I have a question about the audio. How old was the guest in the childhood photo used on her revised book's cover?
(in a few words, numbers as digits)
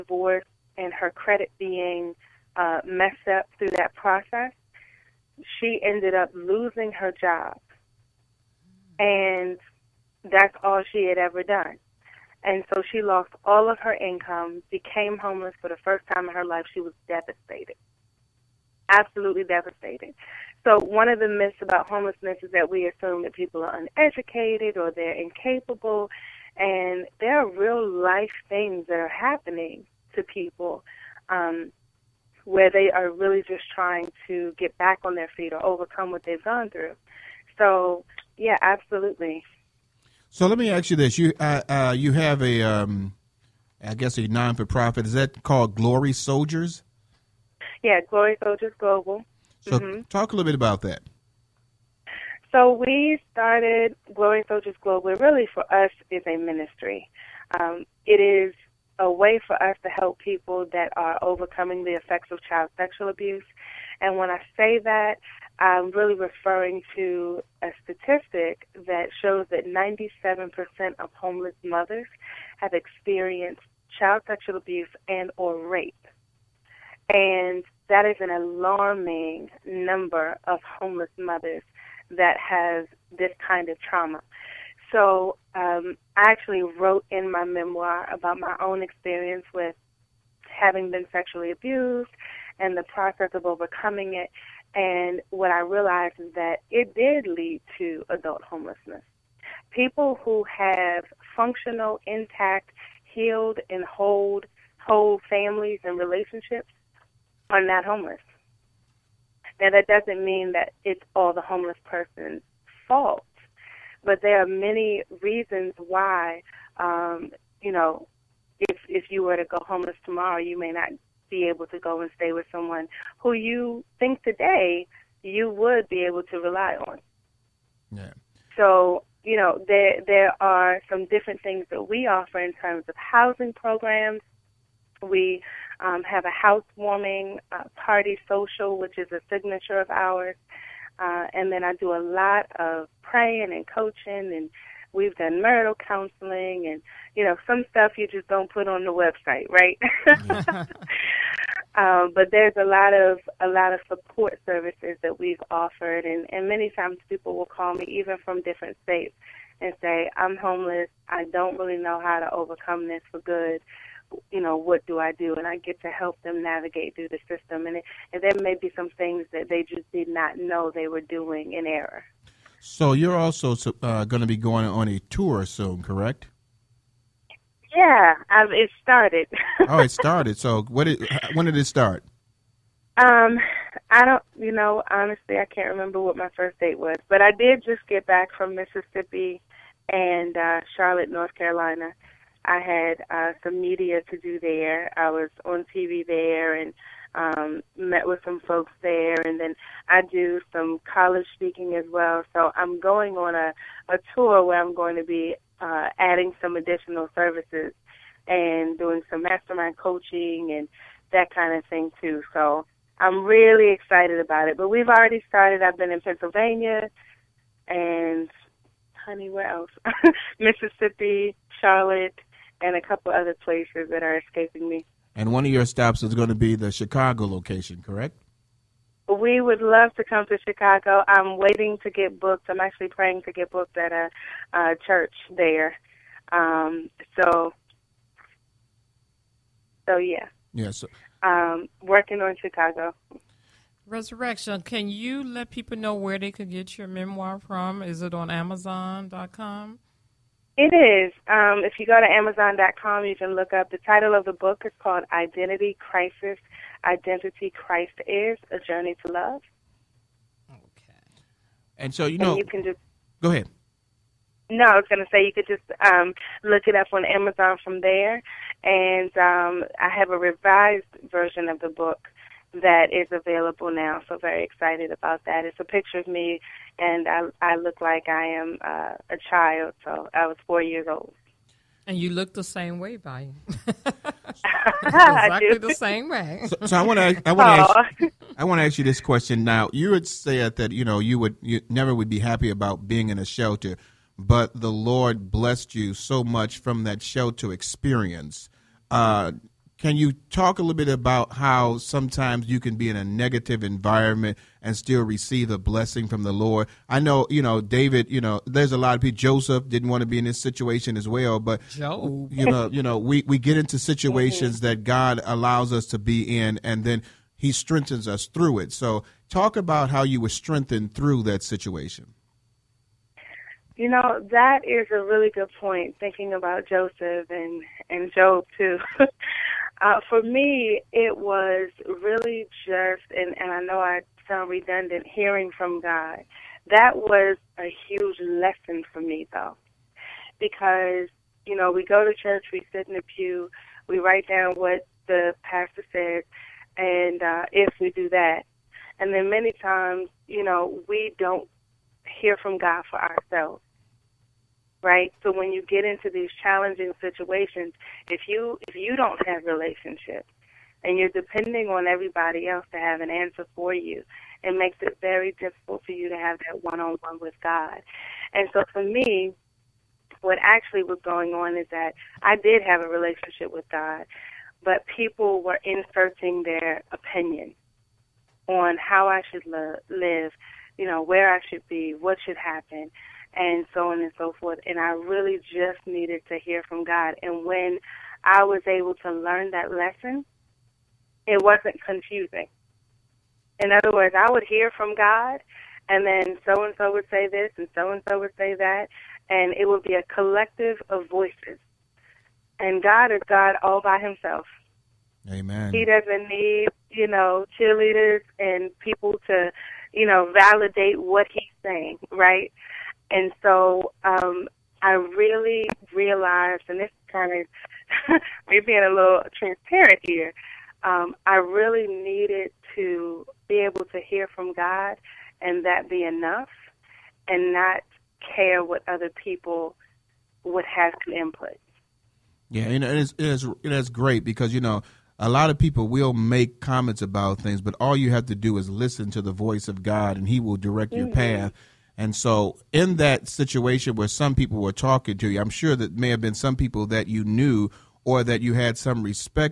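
4.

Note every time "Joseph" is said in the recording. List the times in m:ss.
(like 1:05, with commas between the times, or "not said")
5:09, 5:26.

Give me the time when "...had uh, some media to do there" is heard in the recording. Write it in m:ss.
3:12.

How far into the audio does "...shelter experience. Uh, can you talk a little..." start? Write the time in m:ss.
4:57.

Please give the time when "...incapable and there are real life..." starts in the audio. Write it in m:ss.
0:25.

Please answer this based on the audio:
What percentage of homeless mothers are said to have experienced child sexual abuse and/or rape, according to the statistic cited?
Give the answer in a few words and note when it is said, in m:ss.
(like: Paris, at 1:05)
97%, at 1:09.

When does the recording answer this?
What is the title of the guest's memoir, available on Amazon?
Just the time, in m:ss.
4:15.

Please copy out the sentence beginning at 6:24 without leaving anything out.
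And I really just needed to hear from God.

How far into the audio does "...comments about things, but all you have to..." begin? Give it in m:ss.
7:16.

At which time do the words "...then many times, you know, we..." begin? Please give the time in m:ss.
5:49.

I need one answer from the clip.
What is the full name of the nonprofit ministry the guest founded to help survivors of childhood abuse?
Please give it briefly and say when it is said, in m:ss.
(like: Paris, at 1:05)
Glory Soldiers Global, at 0:48.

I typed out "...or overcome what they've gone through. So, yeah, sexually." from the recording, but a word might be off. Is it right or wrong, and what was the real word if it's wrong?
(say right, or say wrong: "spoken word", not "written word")
wrong: "absolutely", not "sexually".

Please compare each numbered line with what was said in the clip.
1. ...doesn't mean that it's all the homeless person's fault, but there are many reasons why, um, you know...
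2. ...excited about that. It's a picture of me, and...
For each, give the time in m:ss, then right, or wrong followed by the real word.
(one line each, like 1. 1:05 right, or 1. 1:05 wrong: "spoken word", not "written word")
1. 1:49 right
2. 4:34 right.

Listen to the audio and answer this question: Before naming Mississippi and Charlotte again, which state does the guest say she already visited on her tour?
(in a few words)
Pennsylvania.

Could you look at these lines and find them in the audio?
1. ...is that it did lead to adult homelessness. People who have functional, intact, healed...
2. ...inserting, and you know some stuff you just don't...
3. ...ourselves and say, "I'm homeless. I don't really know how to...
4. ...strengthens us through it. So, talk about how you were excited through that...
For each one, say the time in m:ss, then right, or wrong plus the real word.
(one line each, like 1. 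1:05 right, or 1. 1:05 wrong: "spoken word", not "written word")
1. 1:36 right
2. 2:25 wrong: "counseling", not "inserting"
3. 2:38 wrong: "states", not "ourselves"
4. 5:17 wrong: "strengthened", not "excited".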